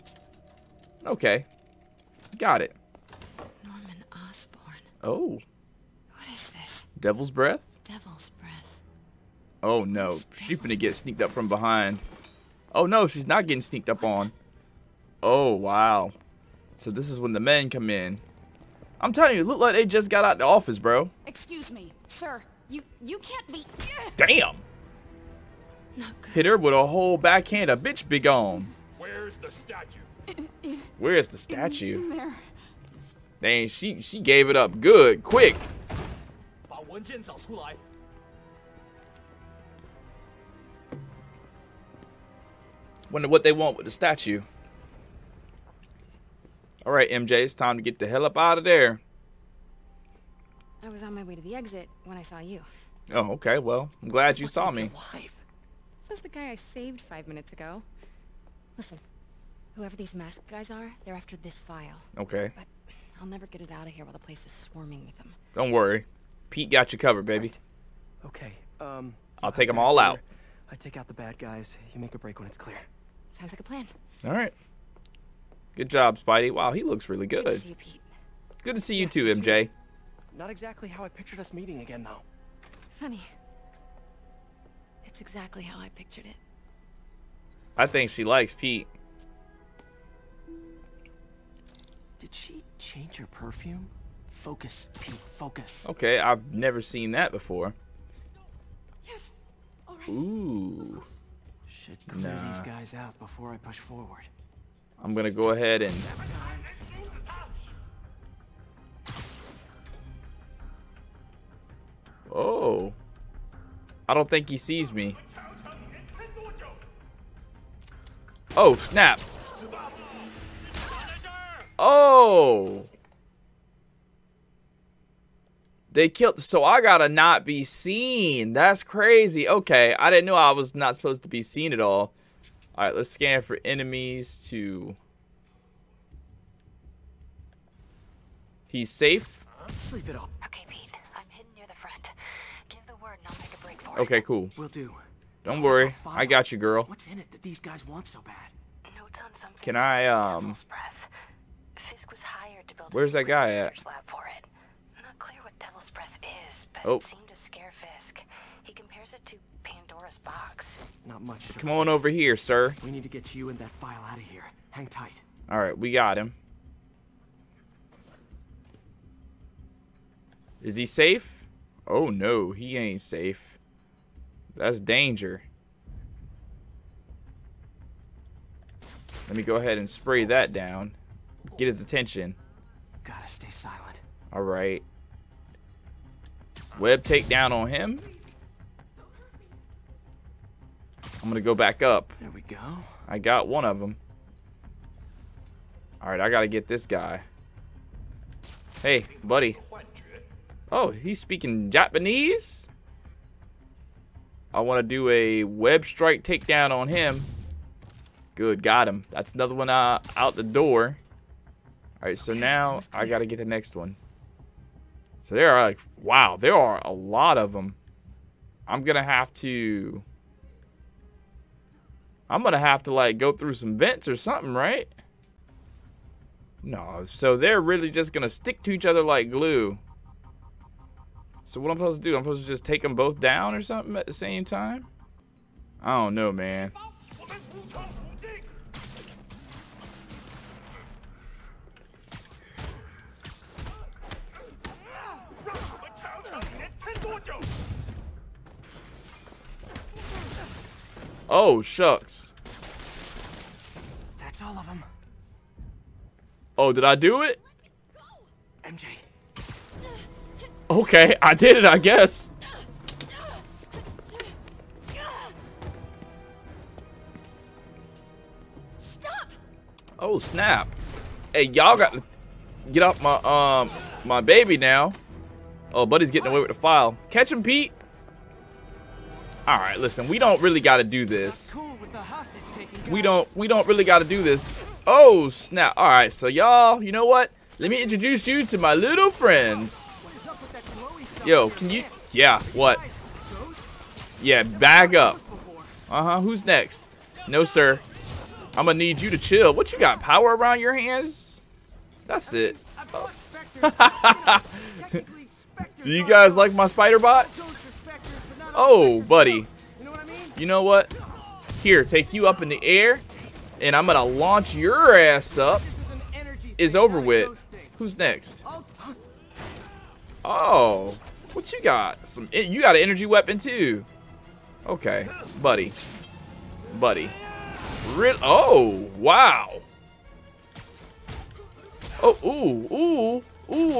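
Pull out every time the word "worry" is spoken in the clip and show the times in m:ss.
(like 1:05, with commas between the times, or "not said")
1:05, 2:25.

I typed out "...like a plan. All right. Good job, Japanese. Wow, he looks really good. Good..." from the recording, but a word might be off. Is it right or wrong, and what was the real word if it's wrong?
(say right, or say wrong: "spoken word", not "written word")
wrong: "Spidey", not "Japanese".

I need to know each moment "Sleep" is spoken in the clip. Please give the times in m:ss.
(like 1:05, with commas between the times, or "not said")
2:19.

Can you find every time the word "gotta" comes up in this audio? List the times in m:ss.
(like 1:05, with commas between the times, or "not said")
2:06, 3:03, 3:16.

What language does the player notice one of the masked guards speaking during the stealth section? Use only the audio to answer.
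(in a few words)
Japanese.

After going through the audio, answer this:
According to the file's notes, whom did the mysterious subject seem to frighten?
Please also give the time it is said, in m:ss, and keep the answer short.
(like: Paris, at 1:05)
Fisk, at 2:37.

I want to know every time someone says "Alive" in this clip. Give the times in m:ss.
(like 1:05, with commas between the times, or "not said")
0:55.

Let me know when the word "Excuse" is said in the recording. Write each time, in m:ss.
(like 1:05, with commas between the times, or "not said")
0:21.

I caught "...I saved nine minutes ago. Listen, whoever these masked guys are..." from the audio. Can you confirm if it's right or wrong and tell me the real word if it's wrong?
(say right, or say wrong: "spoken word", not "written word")
wrong: "five", not "nine".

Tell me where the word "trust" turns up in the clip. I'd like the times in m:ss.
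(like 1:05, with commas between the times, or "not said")
not said.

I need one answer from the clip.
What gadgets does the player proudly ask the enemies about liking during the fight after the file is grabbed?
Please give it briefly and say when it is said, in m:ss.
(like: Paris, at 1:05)
spider bots, at 5:06.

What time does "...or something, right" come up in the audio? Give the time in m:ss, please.
3:44.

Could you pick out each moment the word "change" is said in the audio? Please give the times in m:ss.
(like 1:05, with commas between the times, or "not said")
1:32.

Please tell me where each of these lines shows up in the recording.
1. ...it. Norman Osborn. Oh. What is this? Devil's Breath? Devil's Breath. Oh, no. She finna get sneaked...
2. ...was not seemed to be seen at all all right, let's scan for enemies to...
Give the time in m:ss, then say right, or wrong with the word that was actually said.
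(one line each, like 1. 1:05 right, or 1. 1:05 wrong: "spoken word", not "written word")
1. 0:02 right
2. 2:10 wrong: "supposed", not "seemed".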